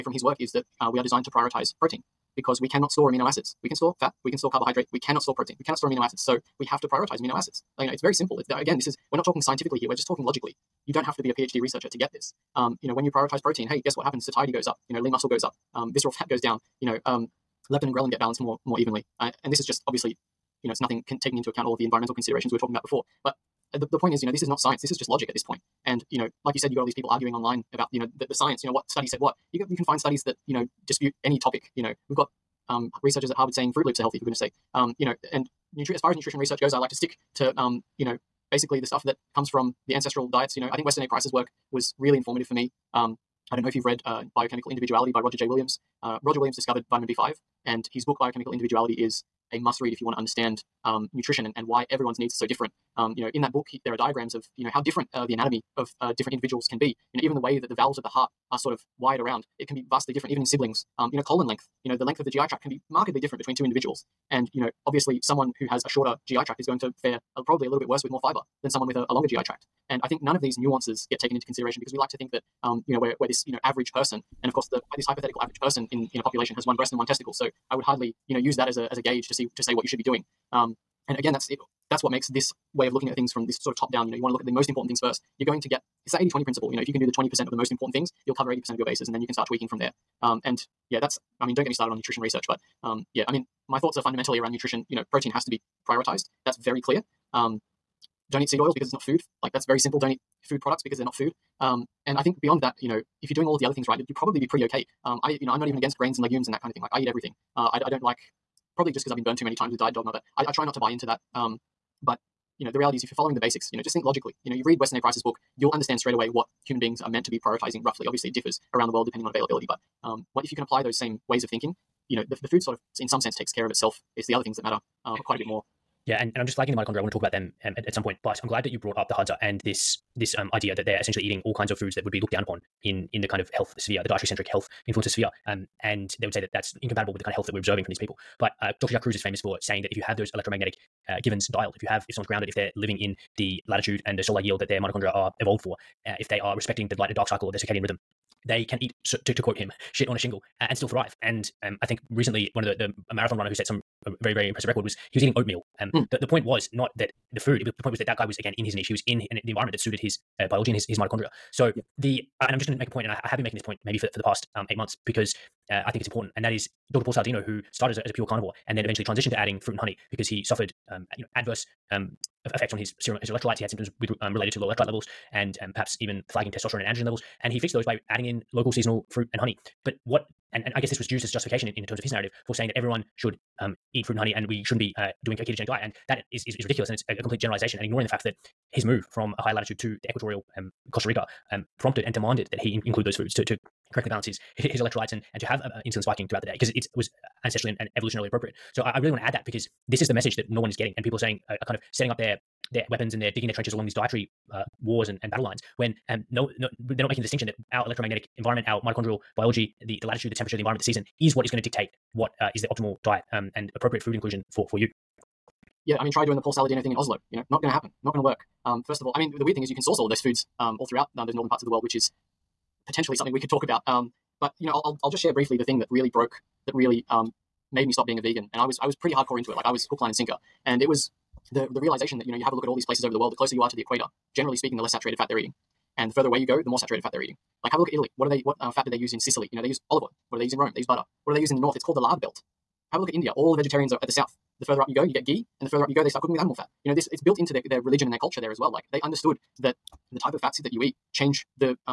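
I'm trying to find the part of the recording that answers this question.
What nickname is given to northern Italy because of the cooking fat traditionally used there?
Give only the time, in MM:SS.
04:01.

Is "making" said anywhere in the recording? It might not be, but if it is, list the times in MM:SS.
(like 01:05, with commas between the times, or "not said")
02:43, 03:27.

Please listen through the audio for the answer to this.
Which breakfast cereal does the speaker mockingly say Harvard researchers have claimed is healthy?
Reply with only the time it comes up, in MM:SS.
00:33.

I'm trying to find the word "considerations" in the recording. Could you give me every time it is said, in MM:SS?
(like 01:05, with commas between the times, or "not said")
00:22, 01:11.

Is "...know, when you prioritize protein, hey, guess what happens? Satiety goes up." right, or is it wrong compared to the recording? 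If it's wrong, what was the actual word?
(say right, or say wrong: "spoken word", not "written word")
right.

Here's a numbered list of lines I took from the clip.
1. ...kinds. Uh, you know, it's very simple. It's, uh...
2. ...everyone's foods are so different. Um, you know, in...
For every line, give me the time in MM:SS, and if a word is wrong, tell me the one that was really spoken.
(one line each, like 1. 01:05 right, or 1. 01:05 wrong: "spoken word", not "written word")
1. 00:07 wrong: "acids", not "kinds"
2. 00:51 wrong: "needs", not "foods".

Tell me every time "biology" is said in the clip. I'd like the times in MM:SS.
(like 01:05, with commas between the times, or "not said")
02:40, 03:29.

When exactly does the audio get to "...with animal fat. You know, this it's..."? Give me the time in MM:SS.
04:06.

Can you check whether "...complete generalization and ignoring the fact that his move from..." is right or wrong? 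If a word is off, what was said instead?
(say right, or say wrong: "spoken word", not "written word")
right.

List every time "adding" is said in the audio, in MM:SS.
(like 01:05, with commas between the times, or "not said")
02:49, 02:58.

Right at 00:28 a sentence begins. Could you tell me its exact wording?
You know what study said what.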